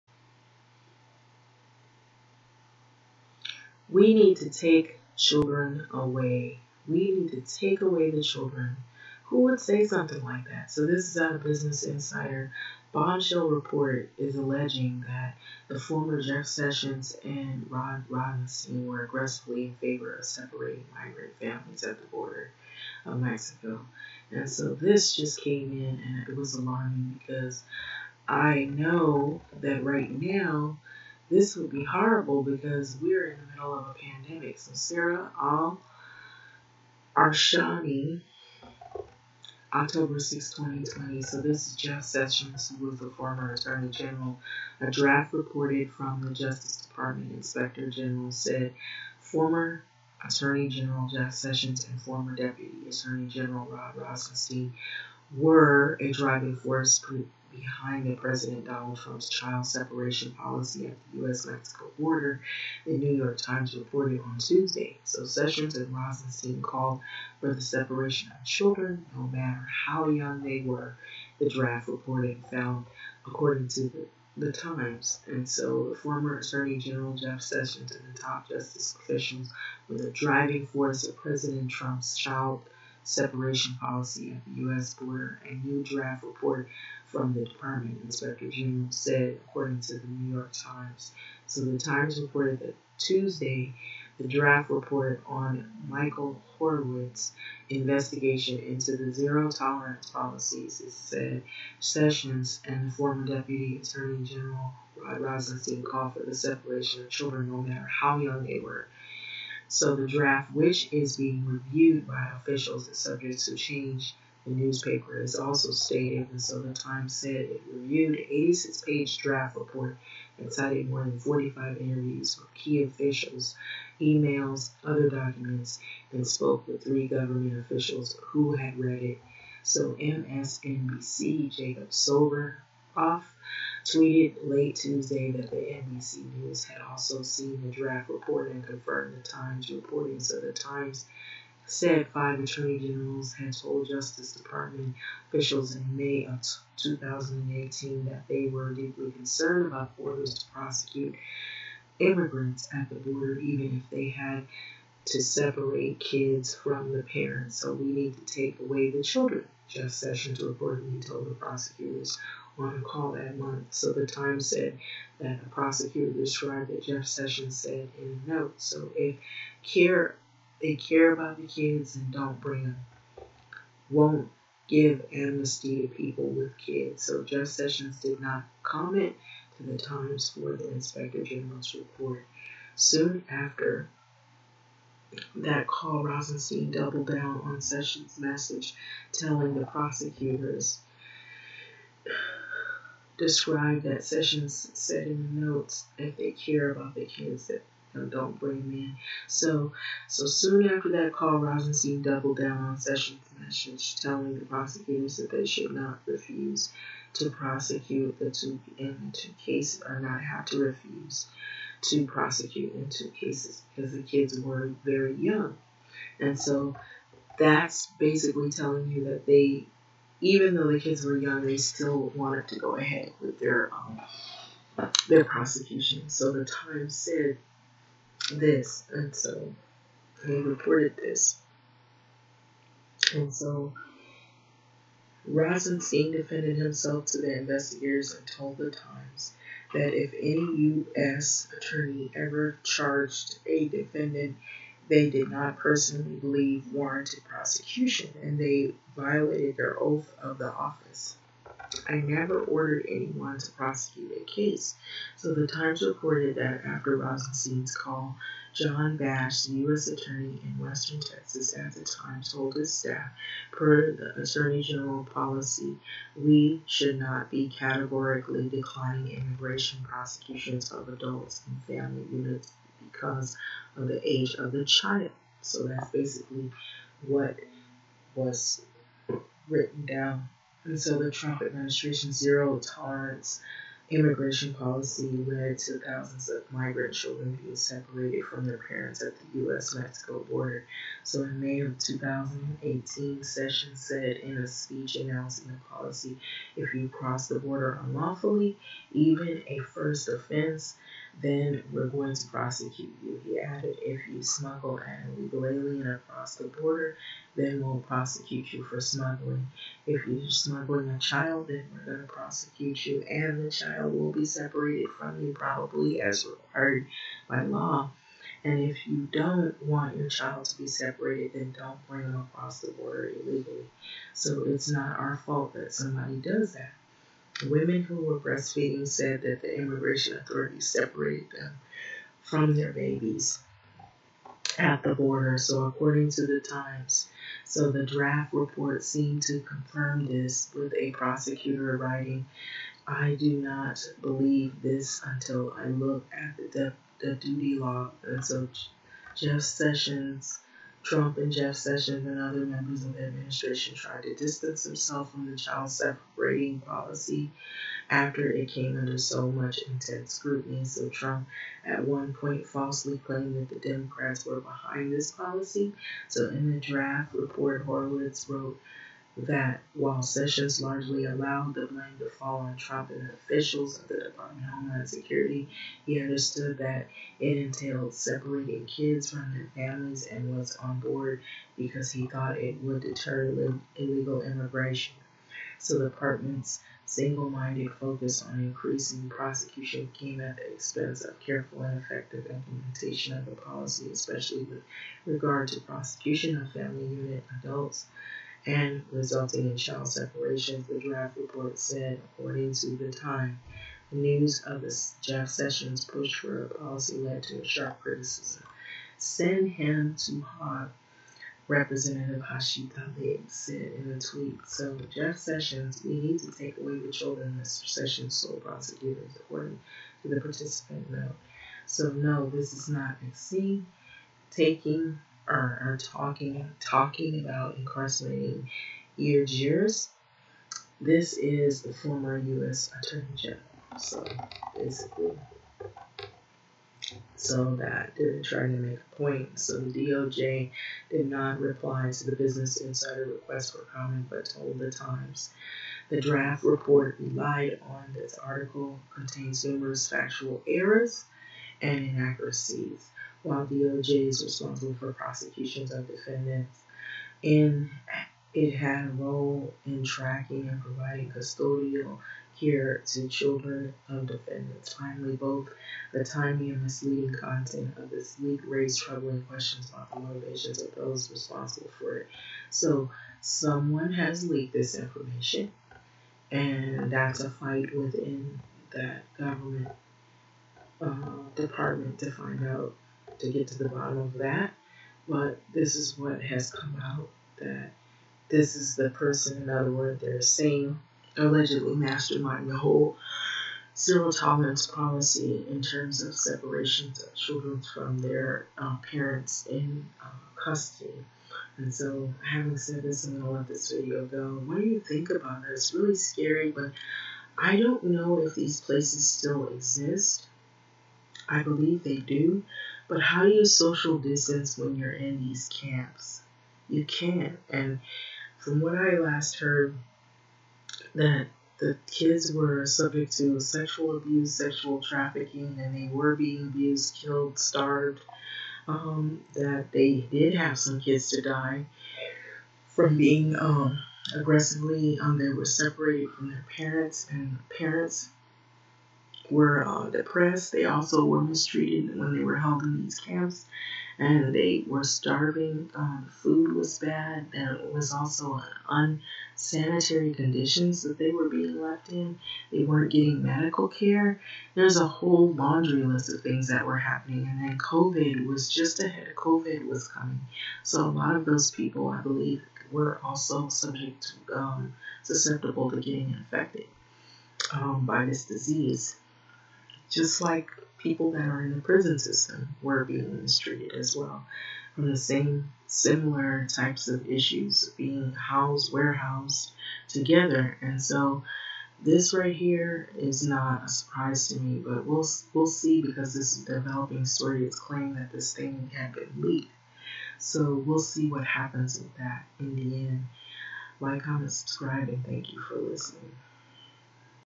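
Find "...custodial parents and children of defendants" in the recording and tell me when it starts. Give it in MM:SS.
07:41.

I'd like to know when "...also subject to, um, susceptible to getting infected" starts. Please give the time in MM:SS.
09:23.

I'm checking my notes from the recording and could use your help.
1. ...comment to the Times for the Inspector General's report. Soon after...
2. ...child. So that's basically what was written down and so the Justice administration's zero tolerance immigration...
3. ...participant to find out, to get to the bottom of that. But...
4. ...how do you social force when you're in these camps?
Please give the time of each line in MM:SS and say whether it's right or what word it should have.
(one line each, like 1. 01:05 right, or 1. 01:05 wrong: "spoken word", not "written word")
1. 02:58 right
2. 04:34 wrong: "Trump", not "Justice"
3. 08:01 wrong: "department", not "participant"
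4. 08:33 wrong: "distance", not "force".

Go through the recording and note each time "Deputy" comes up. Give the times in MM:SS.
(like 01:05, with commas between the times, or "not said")
00:52, 01:43.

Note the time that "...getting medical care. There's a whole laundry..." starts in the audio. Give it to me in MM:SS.
09:12.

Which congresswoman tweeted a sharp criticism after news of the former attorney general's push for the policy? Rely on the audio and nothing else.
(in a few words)
Rashida Tlaib.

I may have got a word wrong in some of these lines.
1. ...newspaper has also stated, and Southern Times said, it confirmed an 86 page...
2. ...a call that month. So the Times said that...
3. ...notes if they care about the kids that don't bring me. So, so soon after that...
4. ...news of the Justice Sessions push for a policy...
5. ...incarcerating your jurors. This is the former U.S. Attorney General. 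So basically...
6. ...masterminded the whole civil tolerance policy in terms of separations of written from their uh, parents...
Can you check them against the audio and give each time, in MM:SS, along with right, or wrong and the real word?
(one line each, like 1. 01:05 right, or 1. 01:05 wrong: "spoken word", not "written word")
1. 01:54 wrong: "reviewed", not "confirmed"
2. 02:42 right
3. 03:15 right
4. 06:43 wrong: "Jeff", not "Justice"
5. 07:07 right
6. 08:11 wrong: "children", not "written".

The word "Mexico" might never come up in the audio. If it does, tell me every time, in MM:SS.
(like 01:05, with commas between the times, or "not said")
00:23, 01:01, 04:49.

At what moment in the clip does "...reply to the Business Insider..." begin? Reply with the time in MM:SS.
07:21.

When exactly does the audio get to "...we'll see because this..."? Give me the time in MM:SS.
09:45.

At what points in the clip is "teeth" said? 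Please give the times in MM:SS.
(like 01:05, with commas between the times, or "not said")
not said.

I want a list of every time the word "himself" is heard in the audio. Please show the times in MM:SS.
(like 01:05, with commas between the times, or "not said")
03:56, 05:54.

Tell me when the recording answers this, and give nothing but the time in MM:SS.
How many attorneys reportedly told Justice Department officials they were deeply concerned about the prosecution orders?
02:22.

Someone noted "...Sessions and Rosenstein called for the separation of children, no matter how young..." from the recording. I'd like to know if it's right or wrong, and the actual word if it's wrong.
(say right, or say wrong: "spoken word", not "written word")
right.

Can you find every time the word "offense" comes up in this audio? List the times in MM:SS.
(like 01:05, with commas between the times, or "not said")
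05:00.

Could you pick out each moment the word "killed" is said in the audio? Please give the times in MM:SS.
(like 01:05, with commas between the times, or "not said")
08:46.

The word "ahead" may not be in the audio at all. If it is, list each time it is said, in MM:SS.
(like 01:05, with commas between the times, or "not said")
03:42, 09:18.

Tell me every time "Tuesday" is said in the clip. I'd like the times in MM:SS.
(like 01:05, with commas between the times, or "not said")
01:04, 01:32, 02:14.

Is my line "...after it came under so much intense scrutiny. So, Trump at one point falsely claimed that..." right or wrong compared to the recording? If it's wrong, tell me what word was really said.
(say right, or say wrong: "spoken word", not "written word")
right.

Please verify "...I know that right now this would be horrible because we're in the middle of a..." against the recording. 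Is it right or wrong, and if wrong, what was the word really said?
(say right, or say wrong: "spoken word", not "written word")
right.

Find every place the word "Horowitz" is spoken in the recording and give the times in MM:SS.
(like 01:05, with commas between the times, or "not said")
01:36, 06:07.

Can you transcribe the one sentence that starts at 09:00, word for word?
They also were mistreated when they were held in these camps, and they were starving.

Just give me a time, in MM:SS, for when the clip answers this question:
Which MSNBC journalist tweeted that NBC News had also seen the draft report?
02:11.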